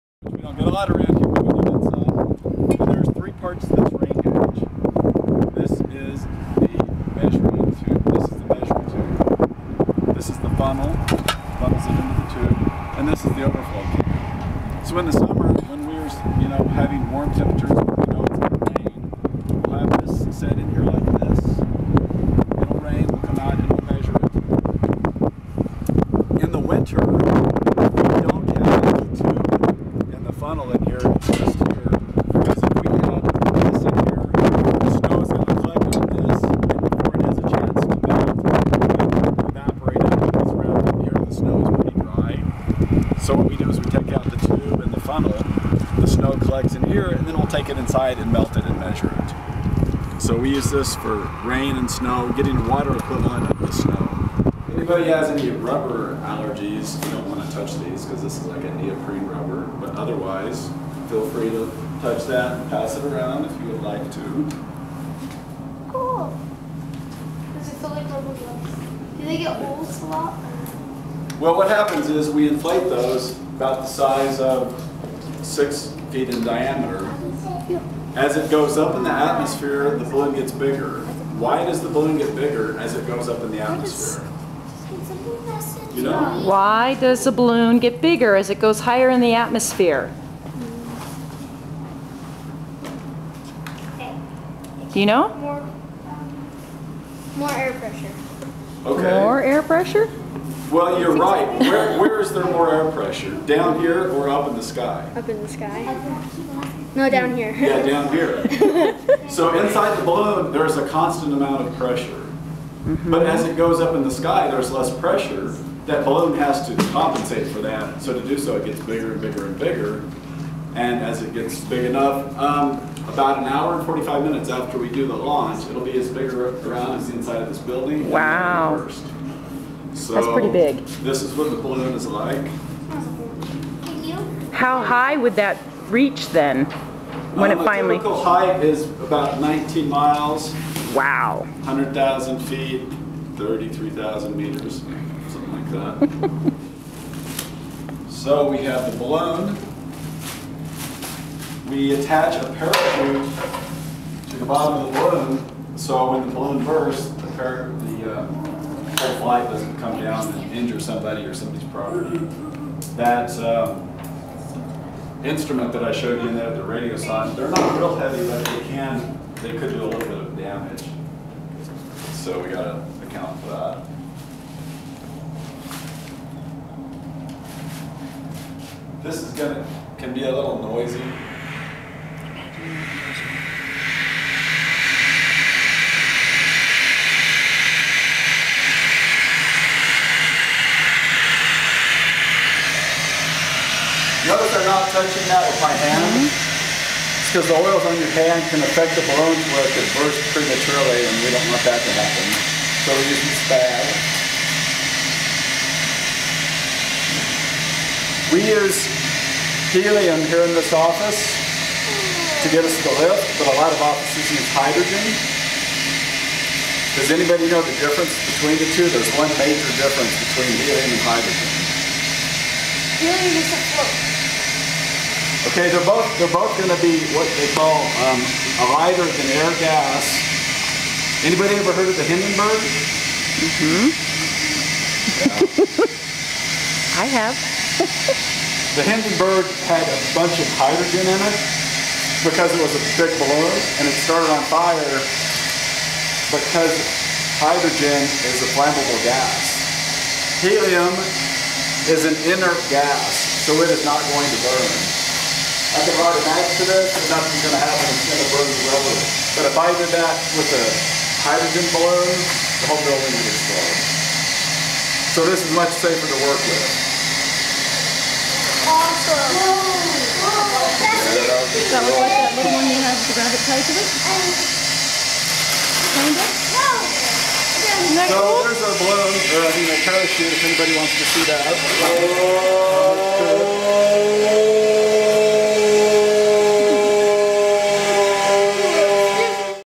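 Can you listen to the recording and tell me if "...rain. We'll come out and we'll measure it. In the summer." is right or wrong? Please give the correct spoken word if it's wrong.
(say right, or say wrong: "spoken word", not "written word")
wrong: "winter", not "summer".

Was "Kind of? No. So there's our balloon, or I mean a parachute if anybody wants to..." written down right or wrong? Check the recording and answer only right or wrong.
right.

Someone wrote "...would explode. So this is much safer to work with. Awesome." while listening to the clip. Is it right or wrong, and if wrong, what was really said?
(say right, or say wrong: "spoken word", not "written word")
right.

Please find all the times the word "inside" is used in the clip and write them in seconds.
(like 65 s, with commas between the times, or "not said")
47 s, 109 s, 127 s.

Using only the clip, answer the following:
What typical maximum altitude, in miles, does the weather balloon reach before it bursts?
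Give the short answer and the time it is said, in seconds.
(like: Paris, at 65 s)
19 miles, at 139 s.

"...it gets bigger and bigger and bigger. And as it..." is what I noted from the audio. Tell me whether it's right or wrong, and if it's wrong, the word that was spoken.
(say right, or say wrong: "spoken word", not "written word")
right.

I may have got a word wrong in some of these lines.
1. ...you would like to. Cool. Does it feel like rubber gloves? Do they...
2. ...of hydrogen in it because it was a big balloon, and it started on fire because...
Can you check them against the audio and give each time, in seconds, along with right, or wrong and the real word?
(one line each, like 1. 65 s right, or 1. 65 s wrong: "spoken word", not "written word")
1. 63 s right
2. 240 s right.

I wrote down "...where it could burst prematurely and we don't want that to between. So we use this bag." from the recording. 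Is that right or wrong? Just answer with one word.
wrong.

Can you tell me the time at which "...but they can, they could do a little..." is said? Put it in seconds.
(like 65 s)
168 s.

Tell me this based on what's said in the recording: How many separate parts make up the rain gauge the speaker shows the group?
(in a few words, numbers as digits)
3.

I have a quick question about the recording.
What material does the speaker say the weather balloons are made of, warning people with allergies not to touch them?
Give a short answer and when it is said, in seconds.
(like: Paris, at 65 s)
neoprene rubber, at 58 s.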